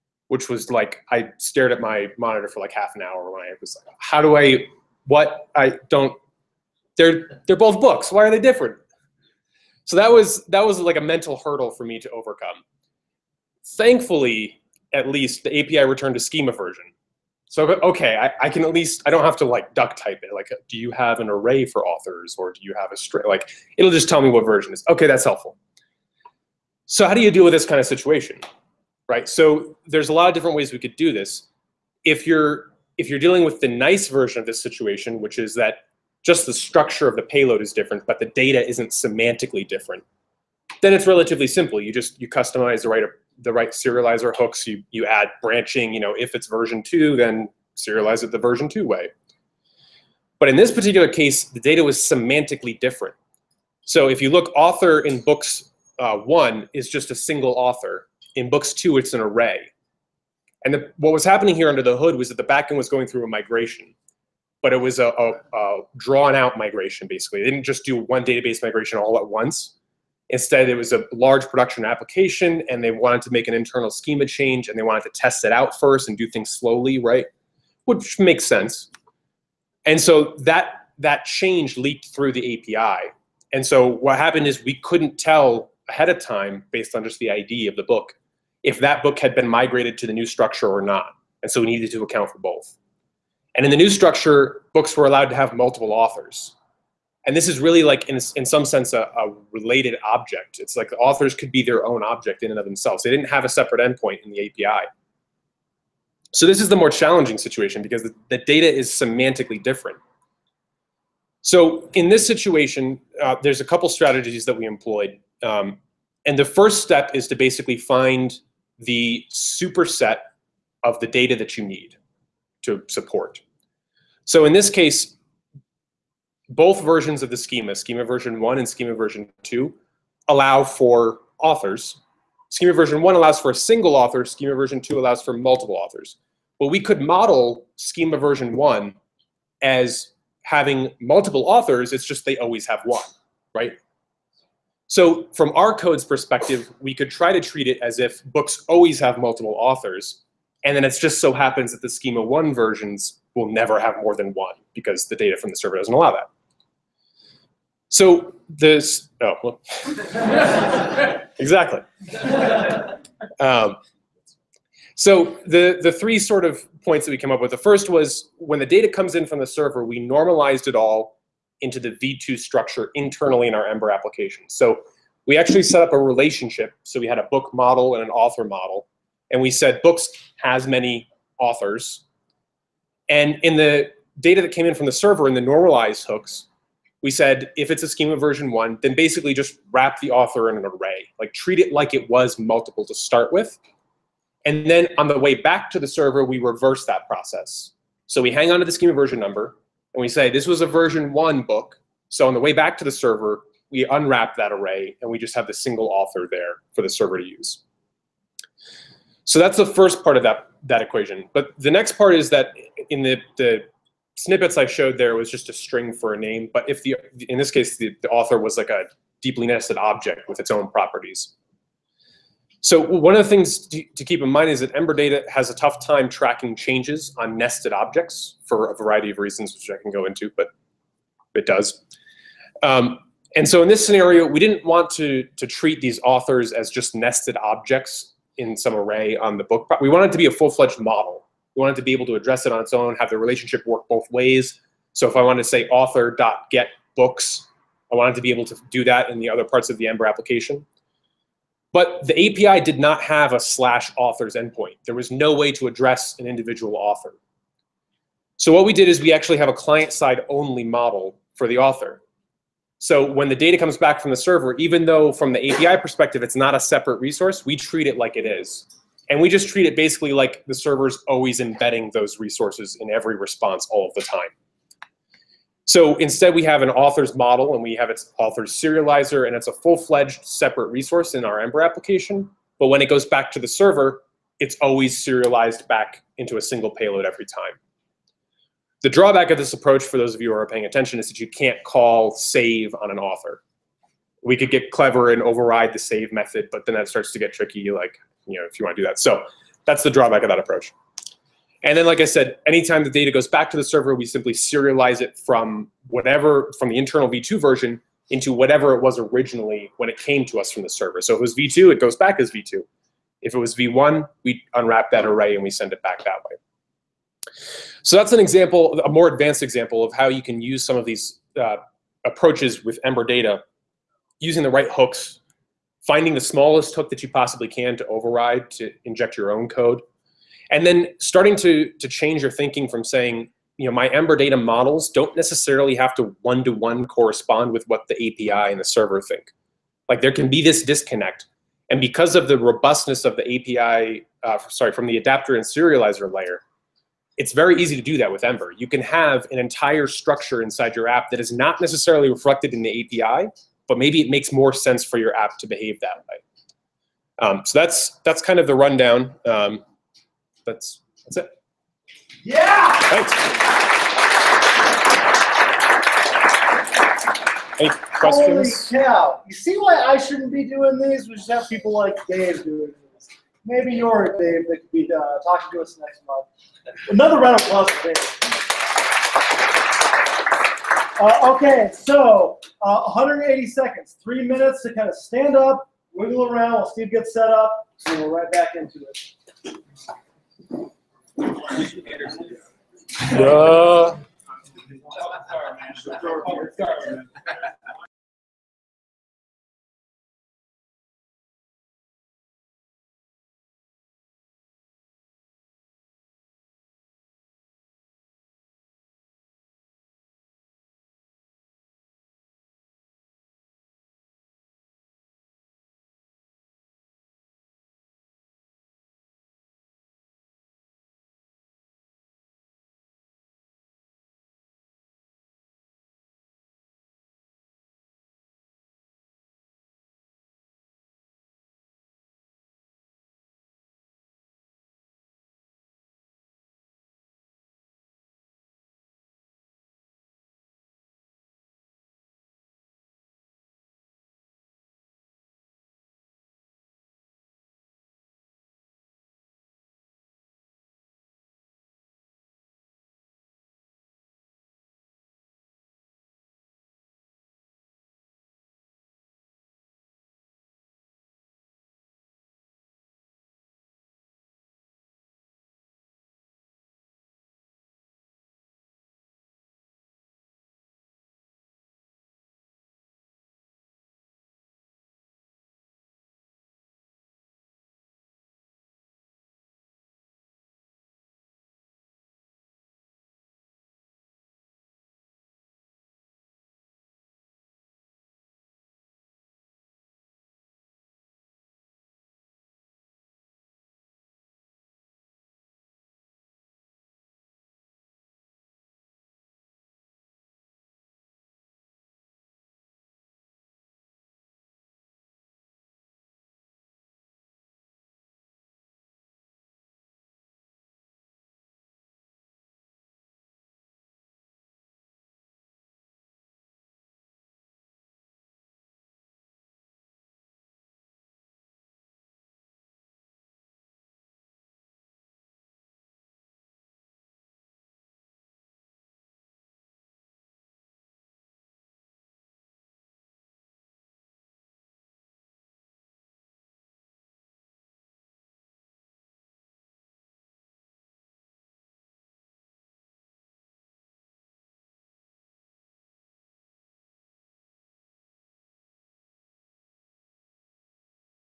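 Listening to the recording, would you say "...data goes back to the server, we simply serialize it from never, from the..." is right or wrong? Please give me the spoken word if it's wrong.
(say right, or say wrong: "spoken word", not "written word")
wrong: "whatever", not "never".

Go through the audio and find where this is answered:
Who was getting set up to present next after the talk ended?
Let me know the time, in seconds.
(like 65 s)
386 s.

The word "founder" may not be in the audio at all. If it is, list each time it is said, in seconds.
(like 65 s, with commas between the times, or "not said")
not said.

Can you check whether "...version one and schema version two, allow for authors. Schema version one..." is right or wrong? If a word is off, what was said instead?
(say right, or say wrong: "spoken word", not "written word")
right.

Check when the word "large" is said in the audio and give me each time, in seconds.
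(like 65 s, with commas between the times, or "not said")
71 s.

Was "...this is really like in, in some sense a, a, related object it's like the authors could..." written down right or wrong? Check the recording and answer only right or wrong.
right.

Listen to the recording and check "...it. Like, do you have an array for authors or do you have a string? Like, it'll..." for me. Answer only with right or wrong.
right.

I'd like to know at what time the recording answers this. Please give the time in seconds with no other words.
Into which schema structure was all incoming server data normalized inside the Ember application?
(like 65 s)
171 s.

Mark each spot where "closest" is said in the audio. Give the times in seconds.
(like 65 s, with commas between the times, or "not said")
not said.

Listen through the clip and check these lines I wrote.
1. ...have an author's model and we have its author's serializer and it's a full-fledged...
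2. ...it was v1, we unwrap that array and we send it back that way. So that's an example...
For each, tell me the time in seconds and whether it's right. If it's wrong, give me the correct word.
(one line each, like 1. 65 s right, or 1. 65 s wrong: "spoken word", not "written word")
1. 276 s right
2. 313 s right.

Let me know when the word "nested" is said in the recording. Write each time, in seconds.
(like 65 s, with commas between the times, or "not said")
219 s, 227 s, 236 s.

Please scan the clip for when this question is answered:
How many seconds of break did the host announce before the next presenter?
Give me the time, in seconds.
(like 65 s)
382 s.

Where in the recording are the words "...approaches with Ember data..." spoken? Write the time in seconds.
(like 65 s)
322 s.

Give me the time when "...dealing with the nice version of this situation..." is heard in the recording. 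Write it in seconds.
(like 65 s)
33 s.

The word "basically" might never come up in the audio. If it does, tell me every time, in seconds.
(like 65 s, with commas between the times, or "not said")
67 s, 117 s, 188 s, 269 s.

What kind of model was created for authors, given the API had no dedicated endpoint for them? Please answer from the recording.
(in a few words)
Client-side only model.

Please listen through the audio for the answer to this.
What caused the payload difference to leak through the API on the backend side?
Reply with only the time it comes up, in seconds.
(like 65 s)
65 s.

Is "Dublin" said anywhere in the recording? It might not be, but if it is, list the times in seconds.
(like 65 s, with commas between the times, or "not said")
not said.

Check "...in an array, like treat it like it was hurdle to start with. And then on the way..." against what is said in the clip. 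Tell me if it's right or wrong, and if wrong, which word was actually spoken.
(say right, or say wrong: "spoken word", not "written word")
wrong: "multiple", not "hurdle".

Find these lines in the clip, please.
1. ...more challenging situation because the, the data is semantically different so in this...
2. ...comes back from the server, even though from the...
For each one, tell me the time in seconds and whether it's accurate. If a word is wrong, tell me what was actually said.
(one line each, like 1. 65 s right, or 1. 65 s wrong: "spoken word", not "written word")
1. 106 s right
2. 263 s right.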